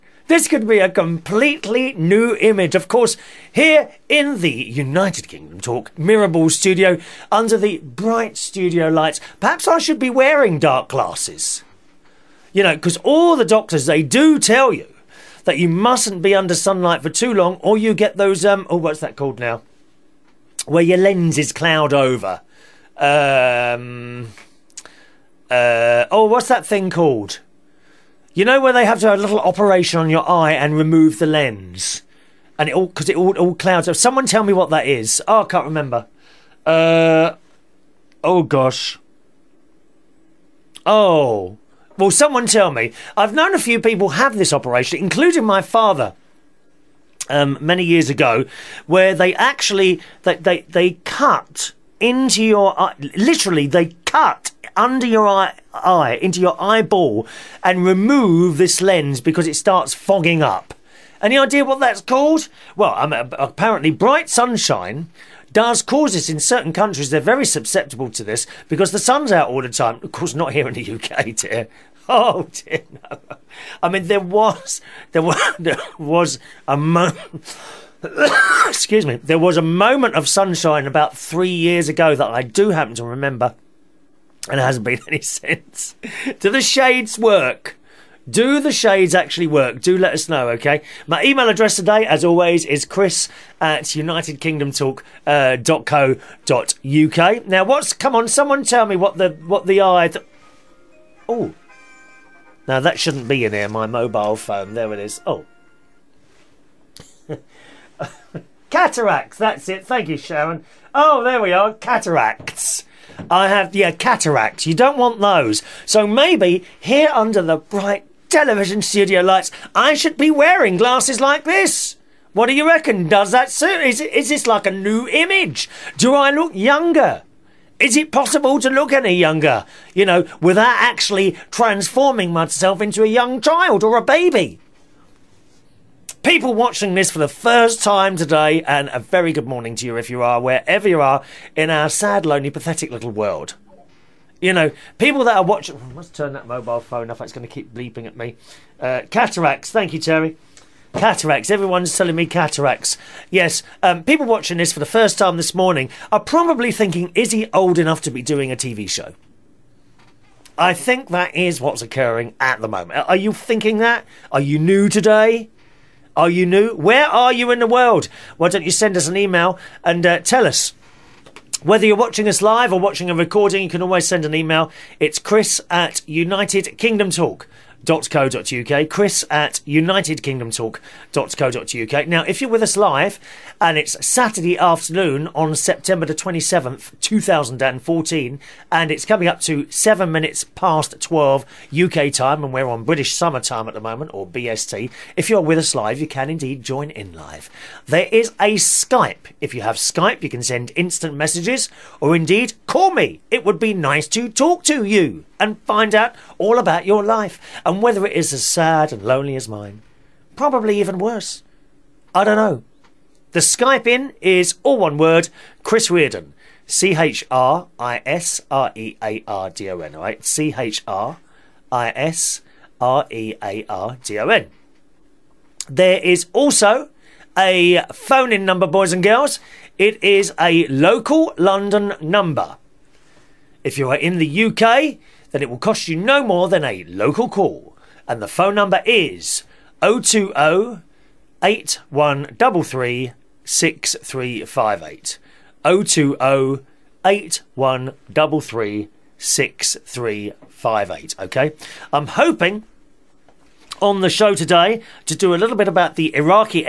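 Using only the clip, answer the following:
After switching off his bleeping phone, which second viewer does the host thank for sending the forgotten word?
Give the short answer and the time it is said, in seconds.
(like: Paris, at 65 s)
Terry, at 149 s.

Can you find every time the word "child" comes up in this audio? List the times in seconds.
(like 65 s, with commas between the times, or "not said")
133 s.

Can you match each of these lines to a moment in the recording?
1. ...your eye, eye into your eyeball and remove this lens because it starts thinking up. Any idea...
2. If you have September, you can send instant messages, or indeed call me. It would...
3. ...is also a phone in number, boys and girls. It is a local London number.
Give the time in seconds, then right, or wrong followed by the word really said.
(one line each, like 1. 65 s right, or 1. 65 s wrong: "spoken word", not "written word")
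1. 55 s wrong: "fogging", not "thinking"
2. 199 s wrong: "Skype", not "September"
3. 226 s right.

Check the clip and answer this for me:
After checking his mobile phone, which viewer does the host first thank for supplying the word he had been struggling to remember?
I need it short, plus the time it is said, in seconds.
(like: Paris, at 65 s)
Sharon, at 110 s.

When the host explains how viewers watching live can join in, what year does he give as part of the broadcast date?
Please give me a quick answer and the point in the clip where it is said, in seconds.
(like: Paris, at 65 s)
2014, at 186 s.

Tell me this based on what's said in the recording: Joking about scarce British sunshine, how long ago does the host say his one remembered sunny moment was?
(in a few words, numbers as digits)
3 years ago.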